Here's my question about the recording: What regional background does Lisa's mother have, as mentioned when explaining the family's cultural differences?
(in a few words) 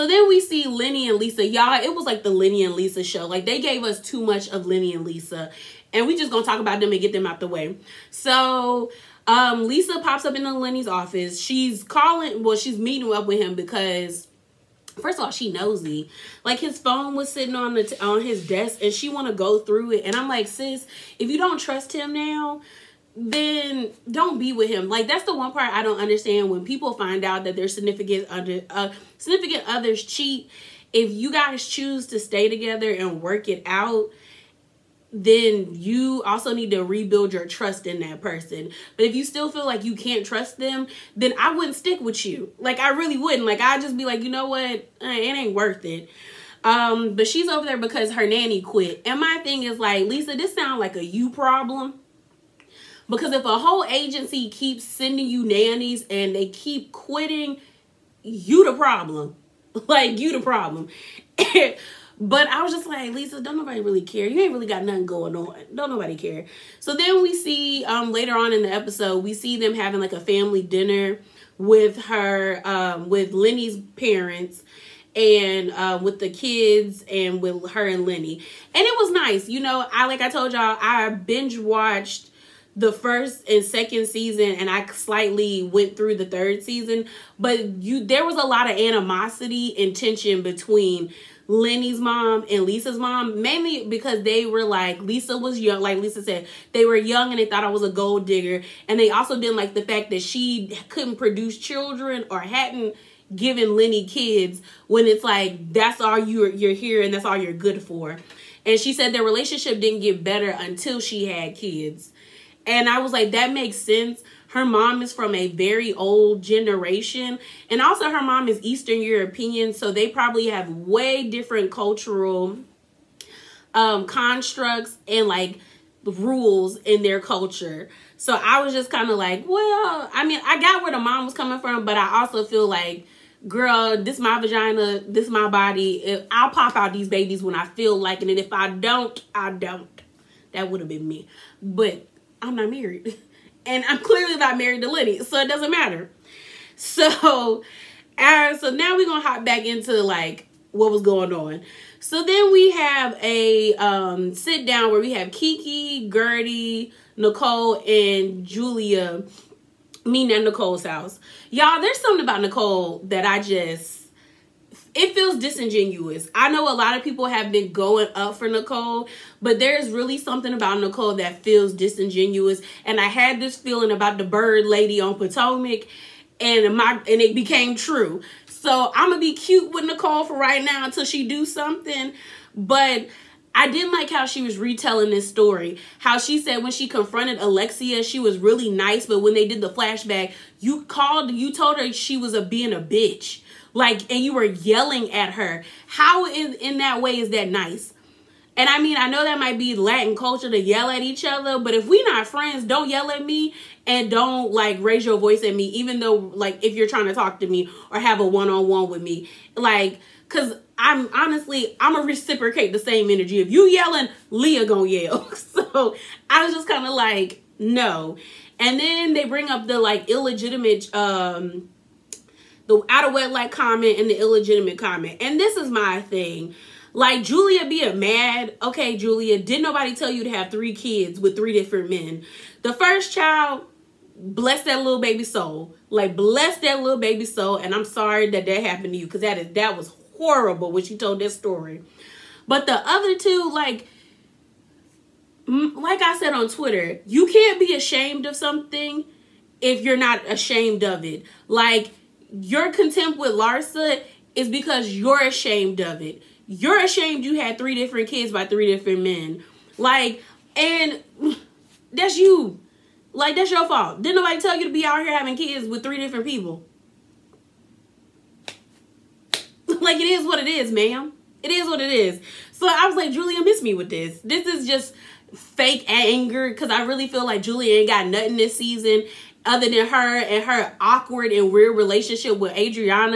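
Eastern European.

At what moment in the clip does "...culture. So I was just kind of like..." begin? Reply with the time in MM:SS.
02:07.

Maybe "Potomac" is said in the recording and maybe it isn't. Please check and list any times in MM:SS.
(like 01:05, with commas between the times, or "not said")
02:55.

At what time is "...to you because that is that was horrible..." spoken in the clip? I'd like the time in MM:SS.
03:58.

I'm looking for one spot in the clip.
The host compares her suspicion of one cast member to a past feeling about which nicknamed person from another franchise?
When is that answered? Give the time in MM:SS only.
02:54.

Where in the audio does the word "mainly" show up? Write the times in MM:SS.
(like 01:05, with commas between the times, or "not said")
01:33.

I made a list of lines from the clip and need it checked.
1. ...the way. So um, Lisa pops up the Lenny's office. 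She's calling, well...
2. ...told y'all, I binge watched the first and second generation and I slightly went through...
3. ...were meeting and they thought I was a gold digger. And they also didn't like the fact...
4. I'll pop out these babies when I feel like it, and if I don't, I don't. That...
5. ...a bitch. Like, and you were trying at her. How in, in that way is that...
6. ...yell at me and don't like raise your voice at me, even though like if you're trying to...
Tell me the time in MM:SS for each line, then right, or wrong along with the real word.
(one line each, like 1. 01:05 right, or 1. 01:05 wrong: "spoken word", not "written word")
1. 00:07 right
2. 01:20 wrong: "season", not "generation"
3. 01:36 wrong: "young", not "meeting"
4. 02:16 right
5. 03:12 wrong: "yelling", not "trying"
6. 03:22 right.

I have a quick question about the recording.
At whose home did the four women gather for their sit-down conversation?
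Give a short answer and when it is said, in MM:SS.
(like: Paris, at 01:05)
Nicole's house, at 02:40.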